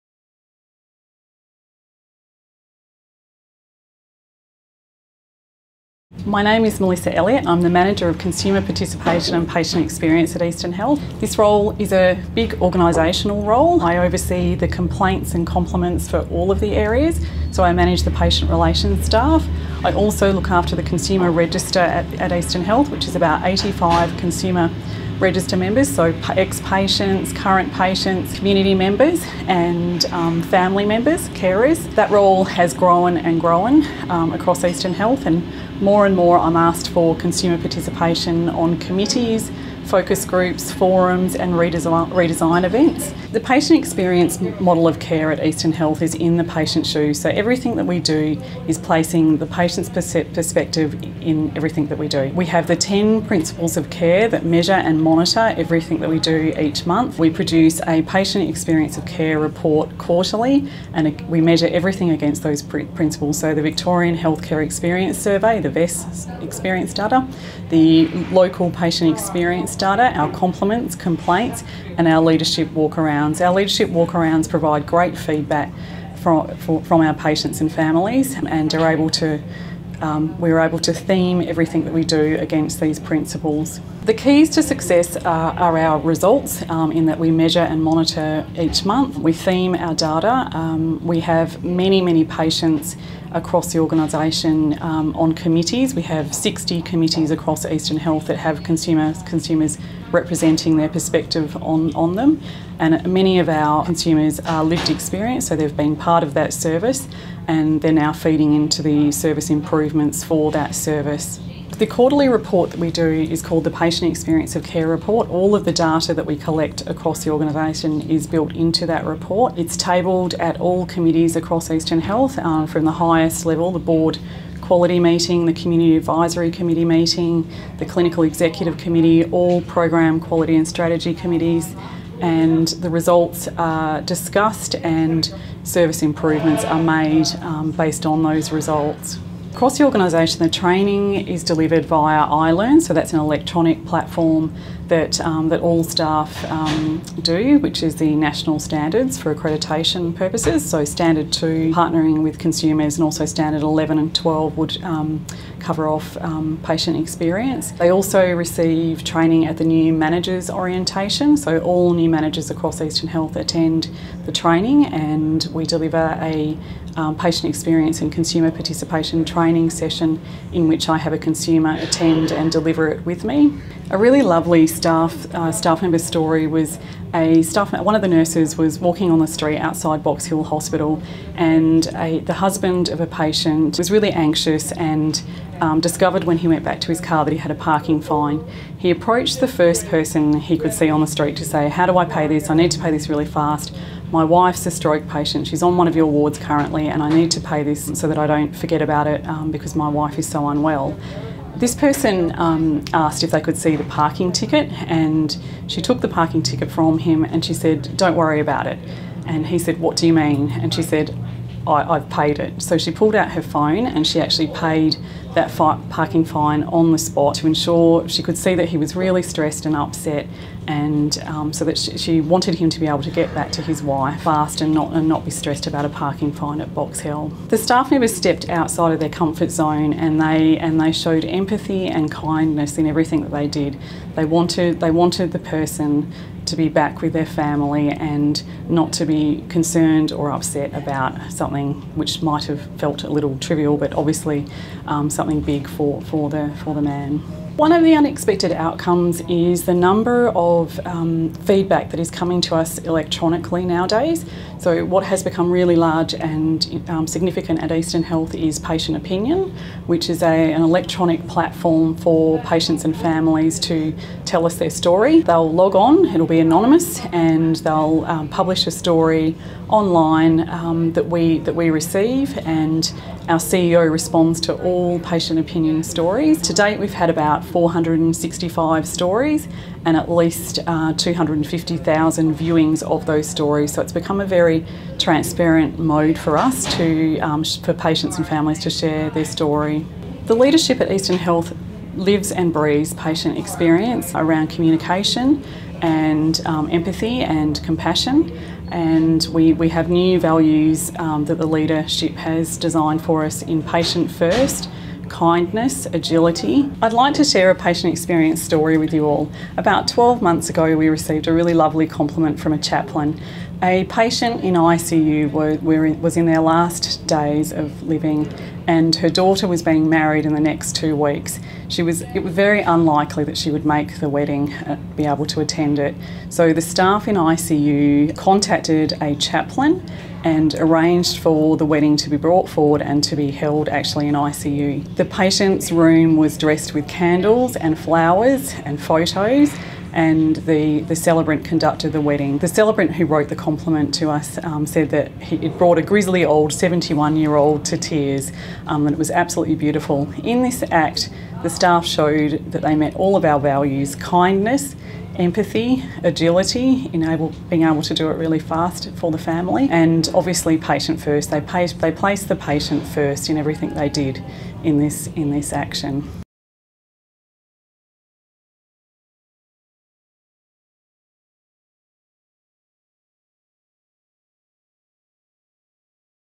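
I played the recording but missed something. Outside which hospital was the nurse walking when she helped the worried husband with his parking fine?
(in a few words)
Box Hill Hospital.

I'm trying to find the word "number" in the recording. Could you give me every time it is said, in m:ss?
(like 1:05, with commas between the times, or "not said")
4:09.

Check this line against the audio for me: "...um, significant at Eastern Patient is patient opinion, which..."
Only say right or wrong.
wrong.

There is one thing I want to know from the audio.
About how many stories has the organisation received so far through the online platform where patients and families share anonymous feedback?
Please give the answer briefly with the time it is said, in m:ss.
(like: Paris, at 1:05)
465, at 4:37.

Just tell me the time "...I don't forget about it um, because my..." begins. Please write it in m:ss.
3:18.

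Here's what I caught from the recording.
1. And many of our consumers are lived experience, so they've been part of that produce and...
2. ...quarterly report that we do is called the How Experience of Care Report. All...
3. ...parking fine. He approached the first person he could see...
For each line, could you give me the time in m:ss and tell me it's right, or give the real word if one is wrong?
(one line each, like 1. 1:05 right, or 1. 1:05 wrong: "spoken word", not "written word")
1. 1:42 wrong: "service", not "produce"
2. 1:51 wrong: "Patient", not "How"
3. 3:07 right.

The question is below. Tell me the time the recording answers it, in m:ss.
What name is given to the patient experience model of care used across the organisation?
0:46.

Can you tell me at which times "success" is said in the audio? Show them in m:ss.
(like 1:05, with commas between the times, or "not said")
1:24.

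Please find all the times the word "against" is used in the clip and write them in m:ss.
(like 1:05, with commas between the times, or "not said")
1:02, 1:22.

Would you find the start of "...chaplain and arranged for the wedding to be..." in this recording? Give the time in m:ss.
5:29.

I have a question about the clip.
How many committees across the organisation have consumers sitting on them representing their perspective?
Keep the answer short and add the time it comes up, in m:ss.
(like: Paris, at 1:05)
60, at 1:36.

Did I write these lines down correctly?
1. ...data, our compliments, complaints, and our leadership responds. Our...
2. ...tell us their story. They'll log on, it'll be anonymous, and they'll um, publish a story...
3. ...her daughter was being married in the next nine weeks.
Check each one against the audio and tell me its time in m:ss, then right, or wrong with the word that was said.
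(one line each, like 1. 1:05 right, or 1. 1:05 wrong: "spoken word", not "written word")
1. 1:09 wrong: "walkarounds", not "responds"
2. 4:24 right
3. 5:18 wrong: "two", not "nine".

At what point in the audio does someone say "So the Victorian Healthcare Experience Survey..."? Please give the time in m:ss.
1:03.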